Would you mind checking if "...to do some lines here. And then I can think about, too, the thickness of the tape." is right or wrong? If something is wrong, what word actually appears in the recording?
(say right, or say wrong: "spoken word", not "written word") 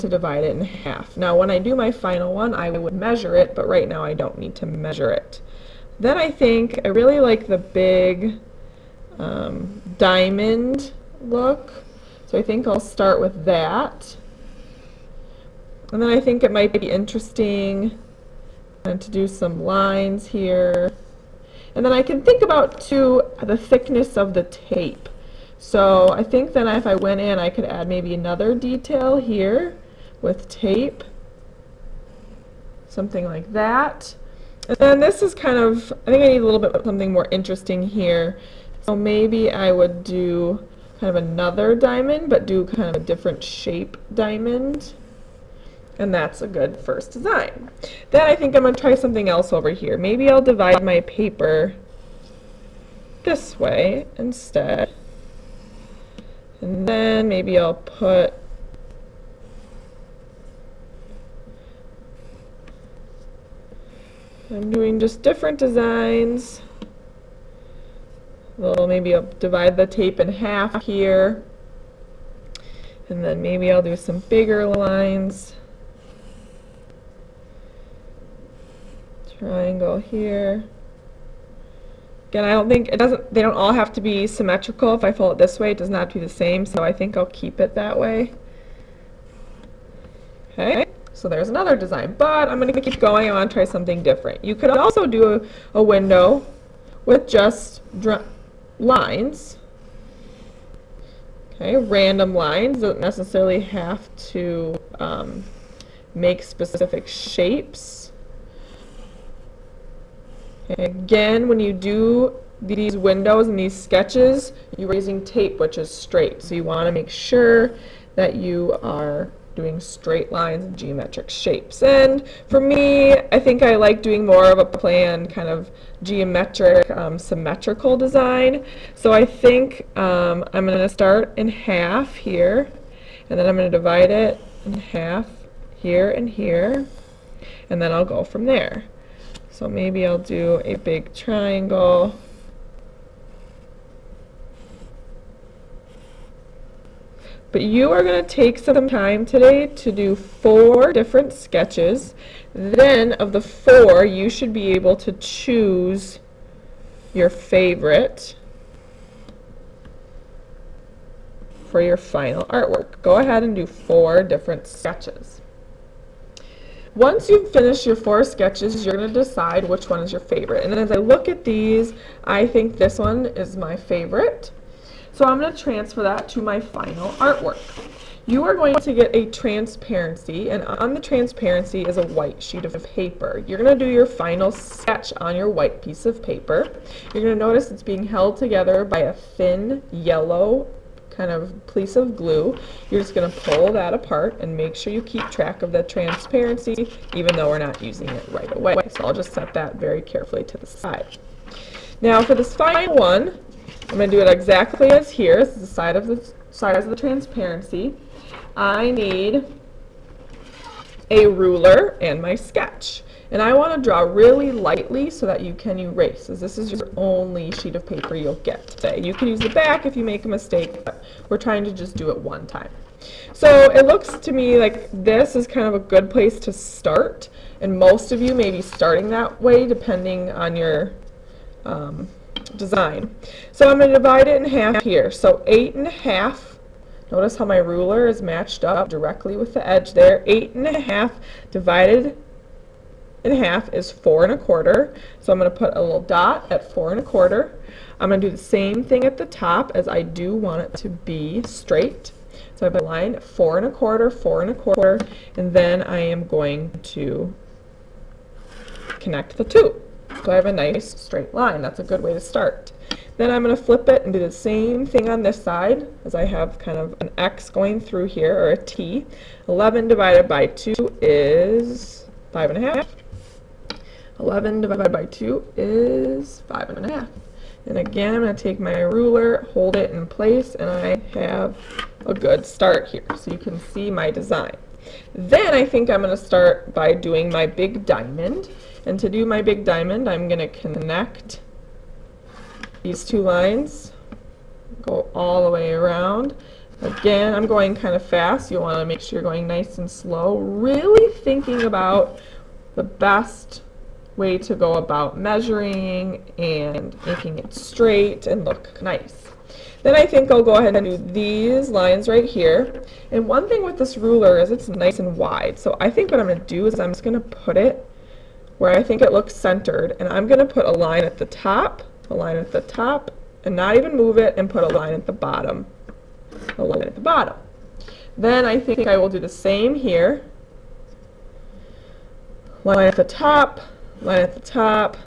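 right.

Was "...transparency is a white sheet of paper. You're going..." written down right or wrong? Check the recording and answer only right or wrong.
right.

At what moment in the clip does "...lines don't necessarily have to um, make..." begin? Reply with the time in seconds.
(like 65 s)
102 s.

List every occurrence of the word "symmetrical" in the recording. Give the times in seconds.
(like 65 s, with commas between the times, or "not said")
84 s, 127 s.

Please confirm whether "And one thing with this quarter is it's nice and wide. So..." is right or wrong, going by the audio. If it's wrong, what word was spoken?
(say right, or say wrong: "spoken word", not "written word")
wrong: "ruler", not "quarter".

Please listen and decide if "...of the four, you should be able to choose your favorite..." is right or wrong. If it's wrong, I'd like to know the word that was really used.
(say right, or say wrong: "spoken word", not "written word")
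right.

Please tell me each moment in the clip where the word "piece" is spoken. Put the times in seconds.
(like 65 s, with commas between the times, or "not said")
185 s, 191 s.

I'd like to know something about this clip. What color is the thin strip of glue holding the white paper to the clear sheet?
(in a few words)
Yellow.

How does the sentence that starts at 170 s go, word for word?
And as I look at these, I think this one is my favorite.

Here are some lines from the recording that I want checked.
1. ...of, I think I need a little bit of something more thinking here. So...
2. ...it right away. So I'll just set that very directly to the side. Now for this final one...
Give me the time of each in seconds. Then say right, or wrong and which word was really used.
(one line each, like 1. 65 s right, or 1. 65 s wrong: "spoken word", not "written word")
1. 35 s wrong: "interesting", not "thinking"
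2. 198 s wrong: "carefully", not "directly".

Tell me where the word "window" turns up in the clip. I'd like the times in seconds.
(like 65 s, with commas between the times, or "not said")
95 s, 112 s.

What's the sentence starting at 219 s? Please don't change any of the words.
You can use the back if you make a mistake, but we're trying to just do it one time.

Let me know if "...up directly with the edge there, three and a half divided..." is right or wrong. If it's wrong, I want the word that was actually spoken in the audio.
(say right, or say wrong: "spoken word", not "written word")
wrong: "eight", not "three".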